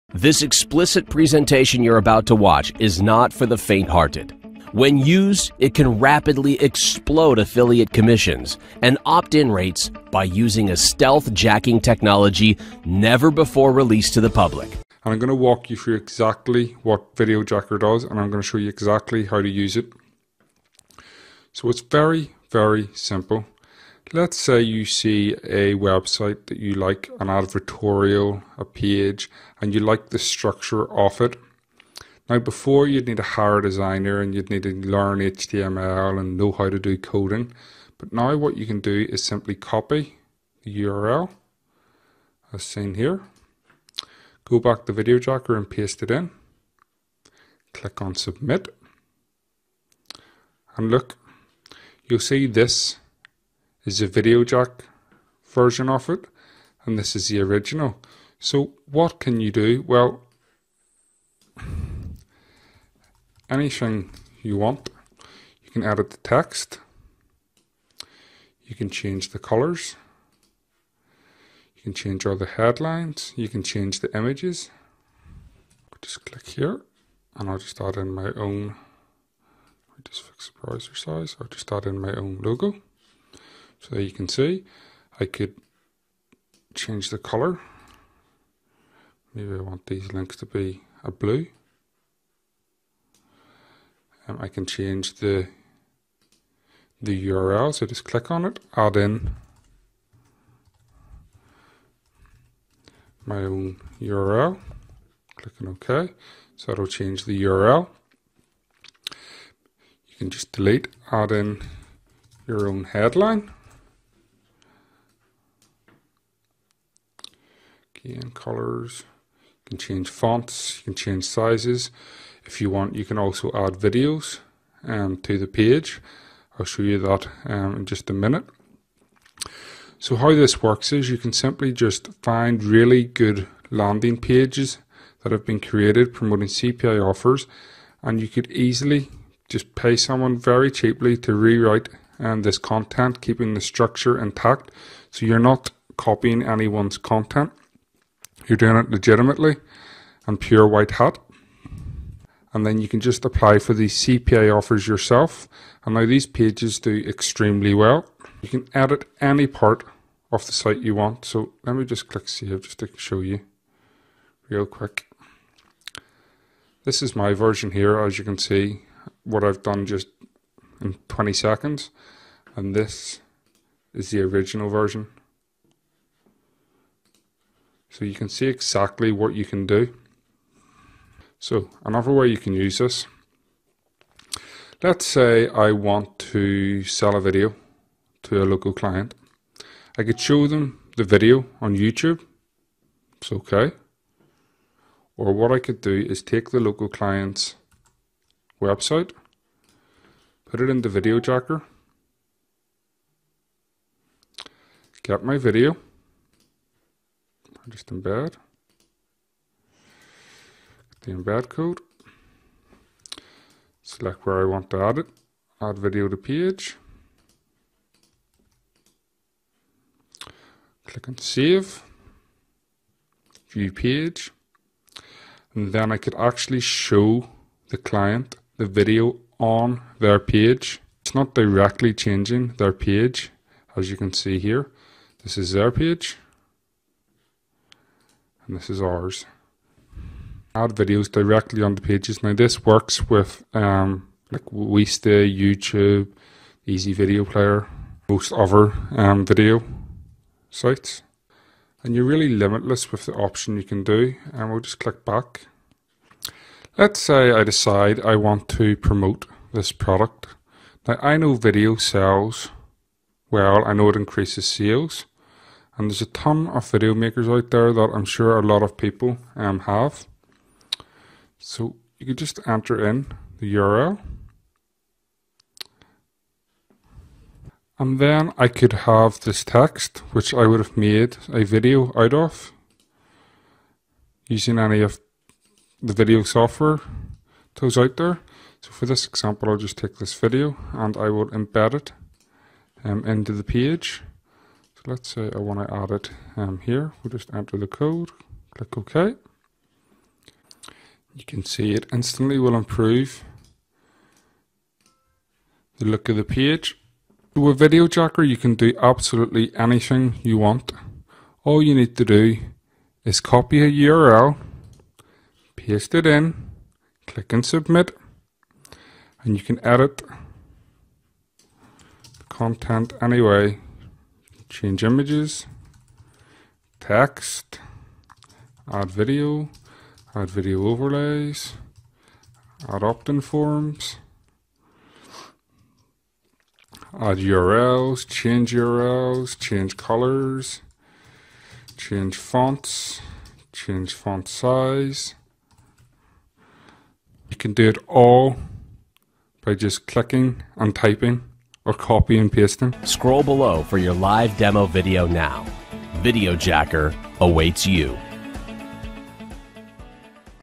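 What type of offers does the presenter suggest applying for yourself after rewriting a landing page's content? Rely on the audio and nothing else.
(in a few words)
CPA offers.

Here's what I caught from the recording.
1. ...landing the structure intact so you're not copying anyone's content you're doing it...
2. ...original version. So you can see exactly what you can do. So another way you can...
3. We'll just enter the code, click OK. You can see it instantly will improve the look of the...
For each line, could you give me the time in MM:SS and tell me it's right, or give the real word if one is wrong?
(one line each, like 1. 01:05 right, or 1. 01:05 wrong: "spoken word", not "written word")
1. 02:23 wrong: "keeping", not "landing"
2. 02:54 right
3. 04:57 right.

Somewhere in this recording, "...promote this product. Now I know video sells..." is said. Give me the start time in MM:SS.
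04:18.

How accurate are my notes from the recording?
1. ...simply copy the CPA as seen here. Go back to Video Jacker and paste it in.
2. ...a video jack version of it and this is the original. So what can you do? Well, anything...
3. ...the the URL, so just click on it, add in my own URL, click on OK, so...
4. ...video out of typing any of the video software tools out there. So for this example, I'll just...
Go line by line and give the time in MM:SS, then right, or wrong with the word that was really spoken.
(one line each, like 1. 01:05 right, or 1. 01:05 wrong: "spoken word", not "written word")
1. 00:39 wrong: "URL", not "CPA"
2. 00:54 right
3. 01:35 right
4. 04:41 wrong: "using", not "typing".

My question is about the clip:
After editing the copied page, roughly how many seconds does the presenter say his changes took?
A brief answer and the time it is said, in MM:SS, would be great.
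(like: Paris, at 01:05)
20 seconds, at 02:51.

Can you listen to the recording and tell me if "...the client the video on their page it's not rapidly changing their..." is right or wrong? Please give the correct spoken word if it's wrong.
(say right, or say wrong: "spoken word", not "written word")
wrong: "directly", not "rapidly".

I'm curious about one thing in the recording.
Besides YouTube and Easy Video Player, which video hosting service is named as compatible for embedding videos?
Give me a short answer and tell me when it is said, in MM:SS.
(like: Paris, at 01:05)
Wistia, at 04:04.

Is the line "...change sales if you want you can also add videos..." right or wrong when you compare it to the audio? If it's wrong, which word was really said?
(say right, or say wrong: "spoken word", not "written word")
wrong: "sizes", not "sales".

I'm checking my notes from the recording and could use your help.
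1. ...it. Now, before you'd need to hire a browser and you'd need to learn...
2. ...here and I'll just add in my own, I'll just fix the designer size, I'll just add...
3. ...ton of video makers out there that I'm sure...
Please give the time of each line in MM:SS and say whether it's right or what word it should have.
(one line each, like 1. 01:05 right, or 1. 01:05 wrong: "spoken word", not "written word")
1. 00:31 wrong: "designer", not "browser"
2. 01:16 wrong: "browser", not "designer"
3. 04:26 right.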